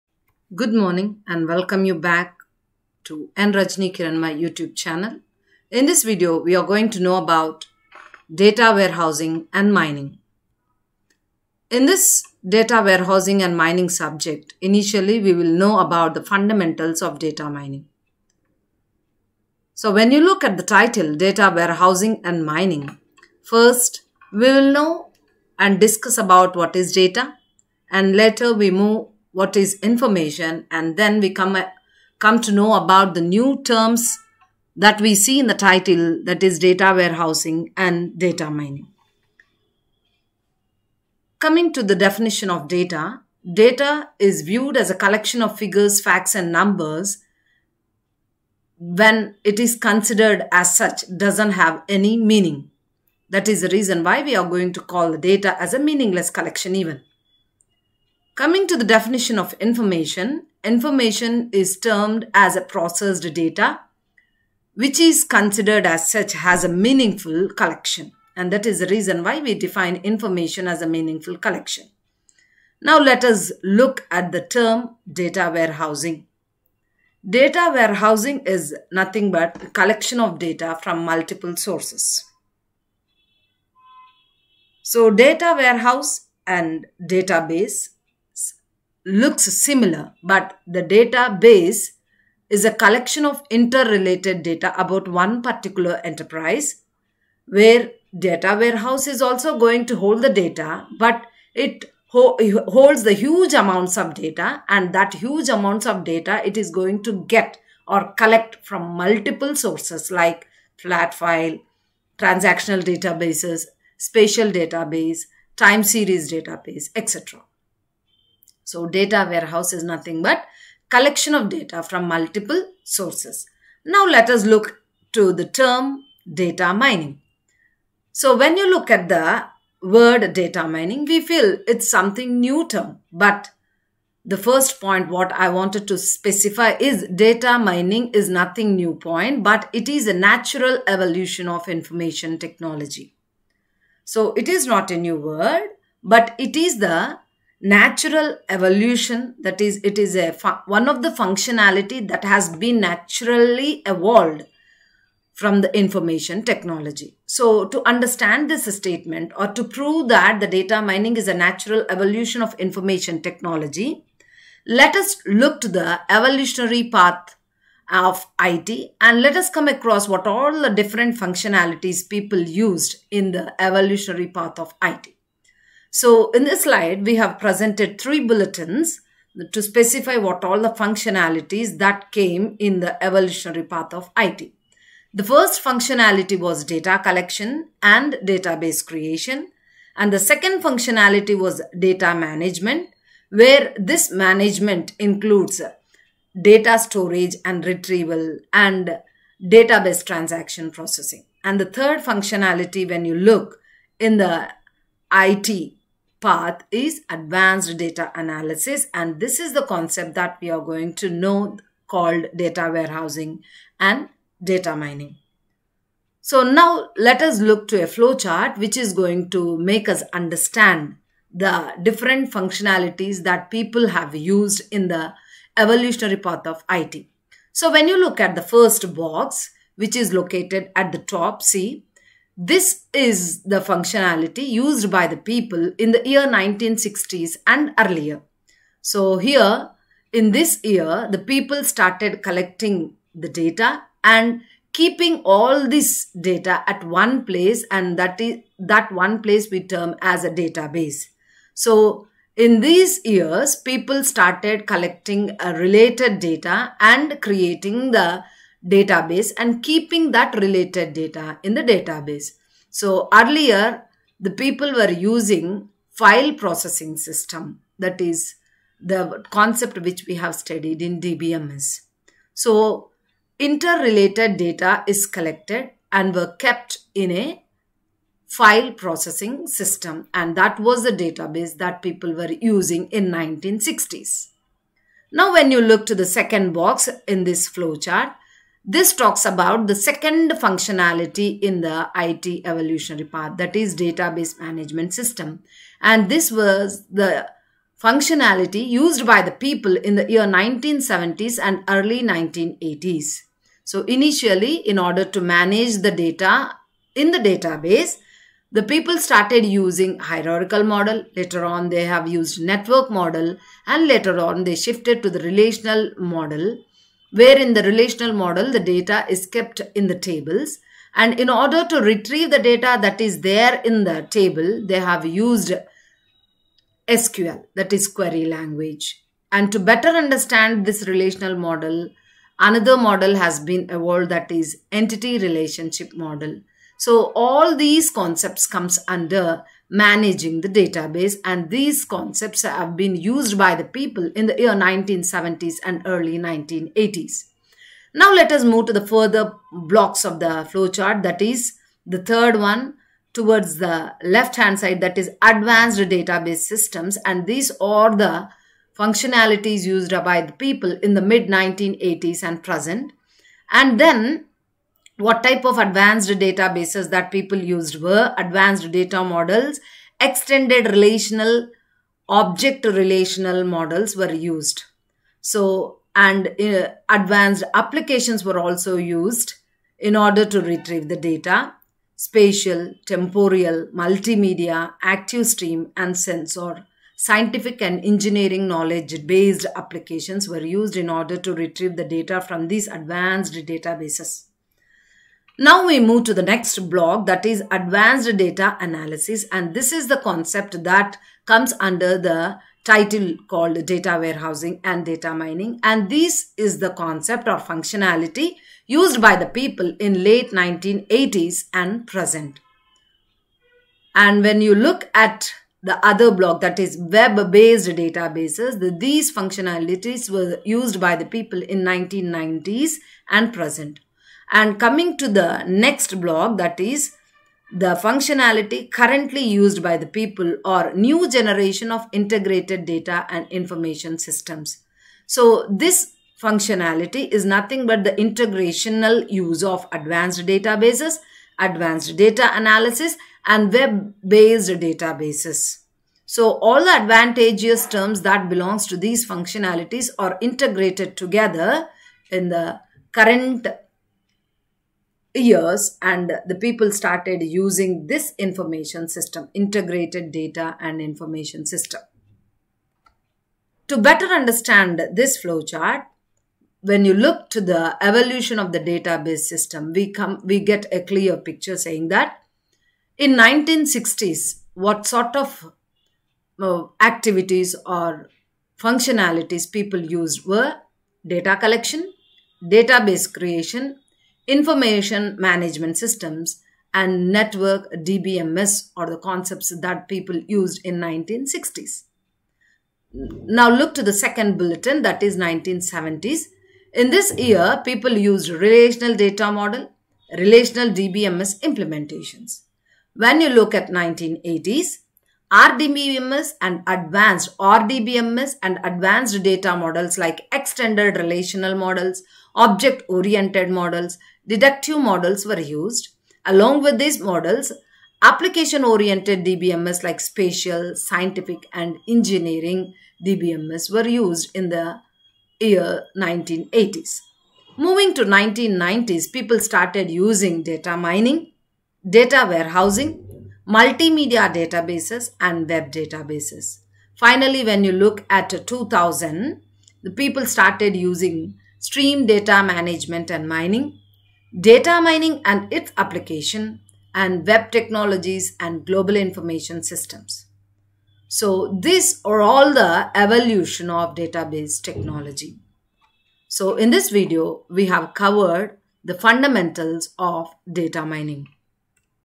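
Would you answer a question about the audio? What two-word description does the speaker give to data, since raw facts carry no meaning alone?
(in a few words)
meaningless collection.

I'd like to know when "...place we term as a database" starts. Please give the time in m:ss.
4:09.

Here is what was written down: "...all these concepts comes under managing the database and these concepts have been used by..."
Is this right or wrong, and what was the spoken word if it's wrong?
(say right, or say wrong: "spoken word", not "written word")
right.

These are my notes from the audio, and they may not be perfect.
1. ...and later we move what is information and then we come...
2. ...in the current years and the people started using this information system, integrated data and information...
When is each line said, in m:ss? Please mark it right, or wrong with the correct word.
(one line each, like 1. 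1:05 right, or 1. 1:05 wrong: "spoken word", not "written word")
1. 0:27 right
2. 7:32 right.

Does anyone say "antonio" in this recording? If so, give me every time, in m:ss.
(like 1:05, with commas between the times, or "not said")
not said.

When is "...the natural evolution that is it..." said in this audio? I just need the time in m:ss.
2:26.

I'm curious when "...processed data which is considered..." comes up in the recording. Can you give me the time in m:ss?
1:02.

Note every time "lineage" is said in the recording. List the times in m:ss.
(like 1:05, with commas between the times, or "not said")
not said.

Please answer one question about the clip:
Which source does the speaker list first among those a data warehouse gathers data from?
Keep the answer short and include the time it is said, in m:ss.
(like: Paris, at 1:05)
flat file, at 1:50.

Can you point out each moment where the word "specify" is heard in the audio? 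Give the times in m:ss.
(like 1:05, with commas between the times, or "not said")
2:15, 2:59.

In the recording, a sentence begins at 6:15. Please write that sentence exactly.
So, and uh, advanced applications were also used in order to retrieve the data spatial, temporal, multimedia, active stream, and sensor.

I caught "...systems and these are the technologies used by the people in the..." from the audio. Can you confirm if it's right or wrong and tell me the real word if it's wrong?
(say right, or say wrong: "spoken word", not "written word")
wrong: "functionalities", not "technologies".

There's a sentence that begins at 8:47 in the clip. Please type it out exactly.
Moving to 1990s, people started using data mining, data warehousing, multimedia databases and web databases.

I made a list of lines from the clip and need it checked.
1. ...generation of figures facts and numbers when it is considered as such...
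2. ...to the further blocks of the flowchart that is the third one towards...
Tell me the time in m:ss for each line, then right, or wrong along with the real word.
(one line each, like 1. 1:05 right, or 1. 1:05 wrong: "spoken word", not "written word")
1. 0:45 wrong: "collection", not "generation"
2. 5:48 right.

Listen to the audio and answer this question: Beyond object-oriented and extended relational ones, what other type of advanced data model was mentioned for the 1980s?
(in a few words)
deductive models.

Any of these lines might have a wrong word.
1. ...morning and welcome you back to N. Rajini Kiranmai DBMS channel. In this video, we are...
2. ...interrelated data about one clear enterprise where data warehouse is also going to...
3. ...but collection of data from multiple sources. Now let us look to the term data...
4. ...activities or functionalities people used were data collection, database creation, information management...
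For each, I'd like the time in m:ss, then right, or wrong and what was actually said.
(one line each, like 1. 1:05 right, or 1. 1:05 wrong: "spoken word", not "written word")
1. 0:00 wrong: "YouTube", not "DBMS"
2. 1:33 wrong: "particular", not "clear"
3. 2:00 right
4. 7:56 right.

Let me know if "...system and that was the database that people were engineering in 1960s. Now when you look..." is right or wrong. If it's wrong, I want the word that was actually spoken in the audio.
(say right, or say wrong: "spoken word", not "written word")
wrong: "using", not "engineering".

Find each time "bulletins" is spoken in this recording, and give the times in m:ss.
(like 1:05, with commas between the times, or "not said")
2:58, 8:14.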